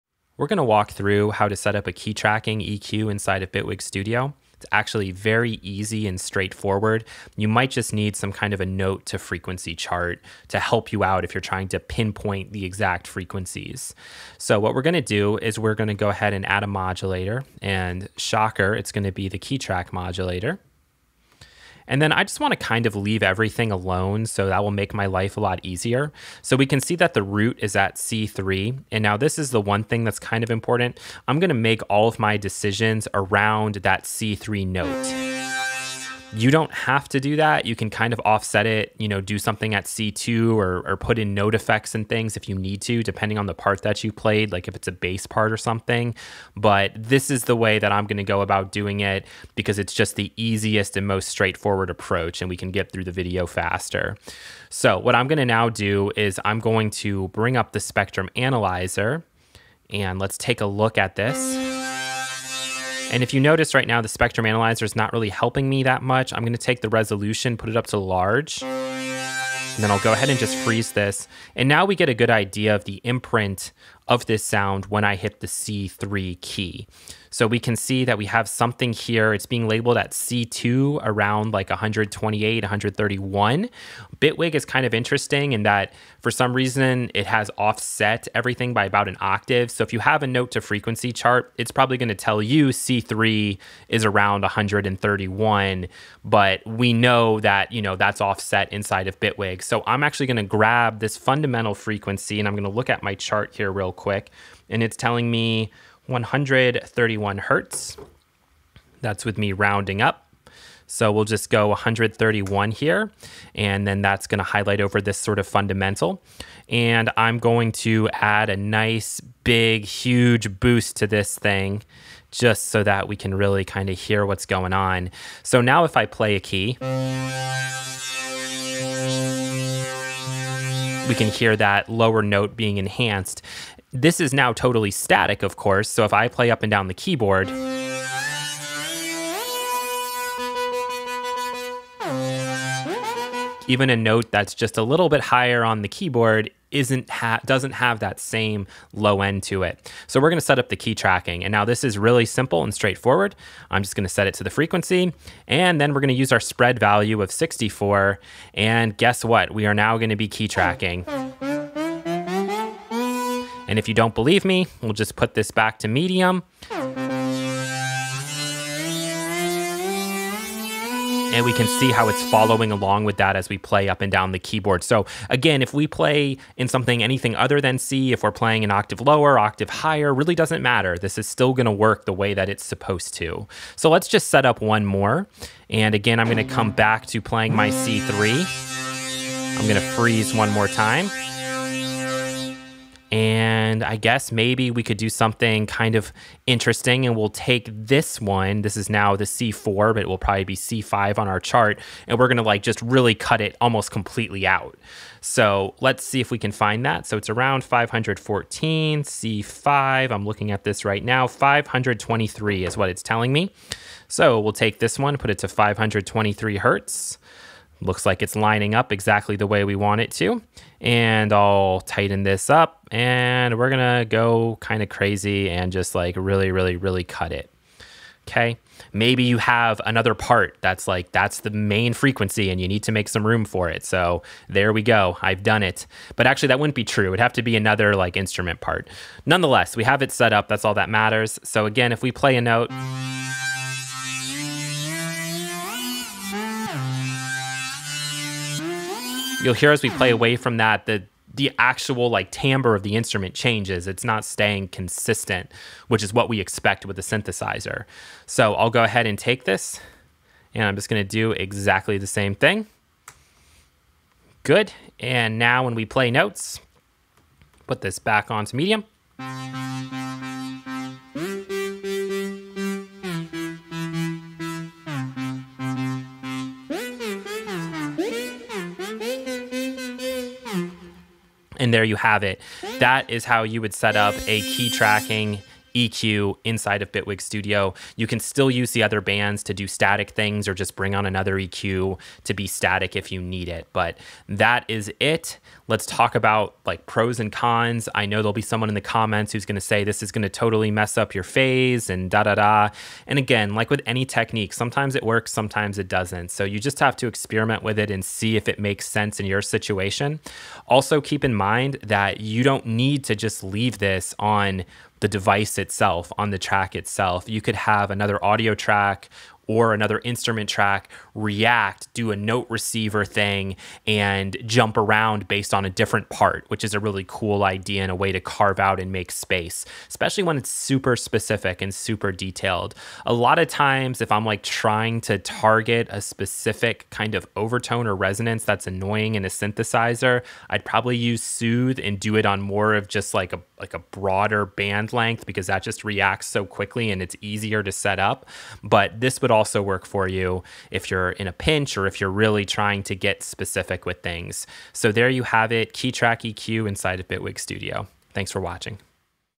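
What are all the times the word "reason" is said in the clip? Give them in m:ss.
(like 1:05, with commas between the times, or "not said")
1:26.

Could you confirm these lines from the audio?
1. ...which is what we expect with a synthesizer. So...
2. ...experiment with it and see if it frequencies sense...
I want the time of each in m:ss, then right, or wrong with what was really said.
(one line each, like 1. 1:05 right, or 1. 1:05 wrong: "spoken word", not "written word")
1. 4:15 right
2. 5:07 wrong: "makes", not "frequencies".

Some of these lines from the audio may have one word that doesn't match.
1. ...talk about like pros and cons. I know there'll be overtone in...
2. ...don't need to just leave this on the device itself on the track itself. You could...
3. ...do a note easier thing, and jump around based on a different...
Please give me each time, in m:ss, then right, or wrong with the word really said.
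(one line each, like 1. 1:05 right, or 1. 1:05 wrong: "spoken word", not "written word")
1. 4:55 wrong: "someone", not "overtone"
2. 5:12 right
3. 5:21 wrong: "receiver", not "easier".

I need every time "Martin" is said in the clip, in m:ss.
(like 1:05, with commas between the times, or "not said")
not said.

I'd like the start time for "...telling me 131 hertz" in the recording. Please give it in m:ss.
1:44.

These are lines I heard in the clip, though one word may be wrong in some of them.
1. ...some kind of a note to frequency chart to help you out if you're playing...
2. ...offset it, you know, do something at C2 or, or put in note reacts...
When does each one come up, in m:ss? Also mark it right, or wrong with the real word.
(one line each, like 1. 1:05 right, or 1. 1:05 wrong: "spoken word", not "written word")
1. 0:08 wrong: "trying", not "playing"
2. 0:38 wrong: "effects", not "reacts".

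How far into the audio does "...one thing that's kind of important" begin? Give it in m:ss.
0:29.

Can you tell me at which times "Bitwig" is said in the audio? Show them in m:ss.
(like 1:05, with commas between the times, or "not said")
0:03, 1:24, 1:39, 4:46, 5:57.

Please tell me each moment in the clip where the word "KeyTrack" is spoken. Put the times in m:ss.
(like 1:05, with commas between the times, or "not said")
5:55.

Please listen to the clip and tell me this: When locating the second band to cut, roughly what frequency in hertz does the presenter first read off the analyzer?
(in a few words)
514.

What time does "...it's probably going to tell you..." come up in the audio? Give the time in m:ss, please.
1:31.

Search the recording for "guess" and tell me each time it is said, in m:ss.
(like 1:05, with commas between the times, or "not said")
2:38, 3:13.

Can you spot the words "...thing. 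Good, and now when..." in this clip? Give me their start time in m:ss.
4:22.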